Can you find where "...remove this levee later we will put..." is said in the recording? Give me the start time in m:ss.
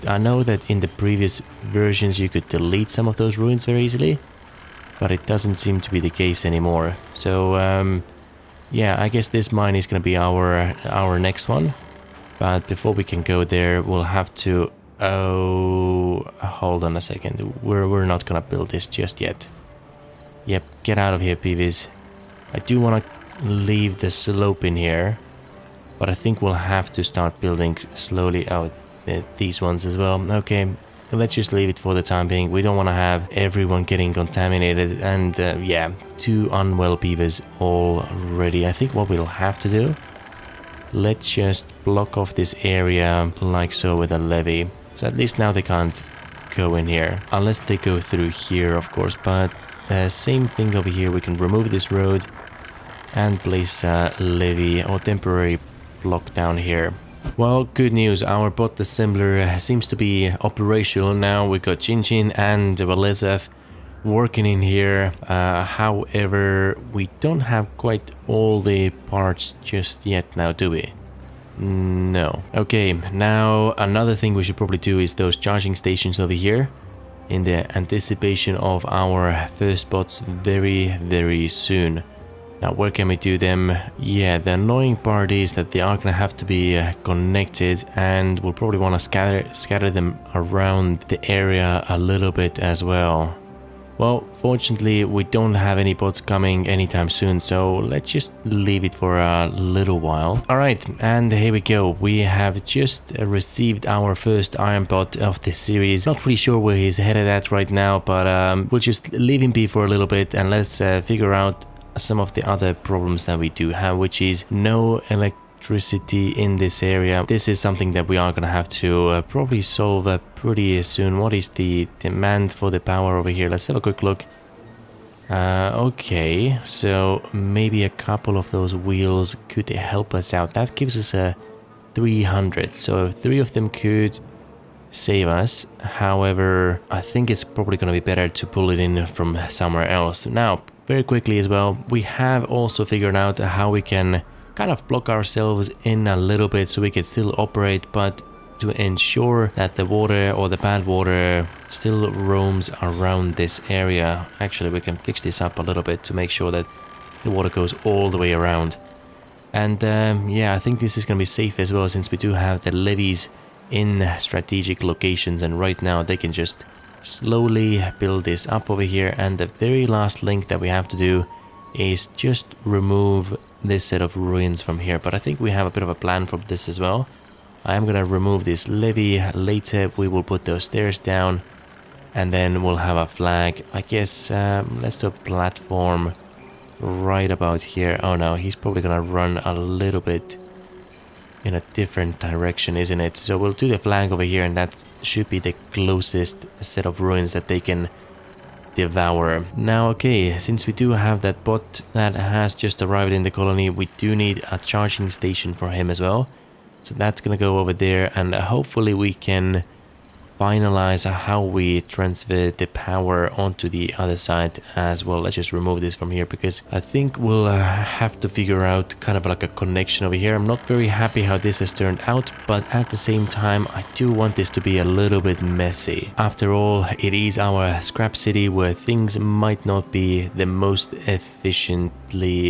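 2:58.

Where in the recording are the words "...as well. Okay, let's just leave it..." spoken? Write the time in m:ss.
0:29.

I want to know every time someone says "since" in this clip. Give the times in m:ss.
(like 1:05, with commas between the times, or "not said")
2:41, 3:20.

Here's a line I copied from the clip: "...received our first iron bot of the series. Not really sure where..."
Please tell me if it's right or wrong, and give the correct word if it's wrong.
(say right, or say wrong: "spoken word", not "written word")
right.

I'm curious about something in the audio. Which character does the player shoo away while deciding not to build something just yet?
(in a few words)
Peeves.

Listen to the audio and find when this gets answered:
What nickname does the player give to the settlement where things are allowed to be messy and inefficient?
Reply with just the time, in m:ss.
3:47.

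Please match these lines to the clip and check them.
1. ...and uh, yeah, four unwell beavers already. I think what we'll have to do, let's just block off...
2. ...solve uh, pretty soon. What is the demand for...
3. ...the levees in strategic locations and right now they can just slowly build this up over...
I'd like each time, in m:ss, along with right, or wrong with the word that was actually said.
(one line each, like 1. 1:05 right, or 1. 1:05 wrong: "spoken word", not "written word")
1. 0:35 wrong: "two", not "four"
2. 1:59 right
3. 2:42 right.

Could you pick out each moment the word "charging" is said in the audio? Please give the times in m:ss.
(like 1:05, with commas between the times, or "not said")
1:15, 3:24.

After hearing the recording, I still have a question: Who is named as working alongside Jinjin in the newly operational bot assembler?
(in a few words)
Valezeth.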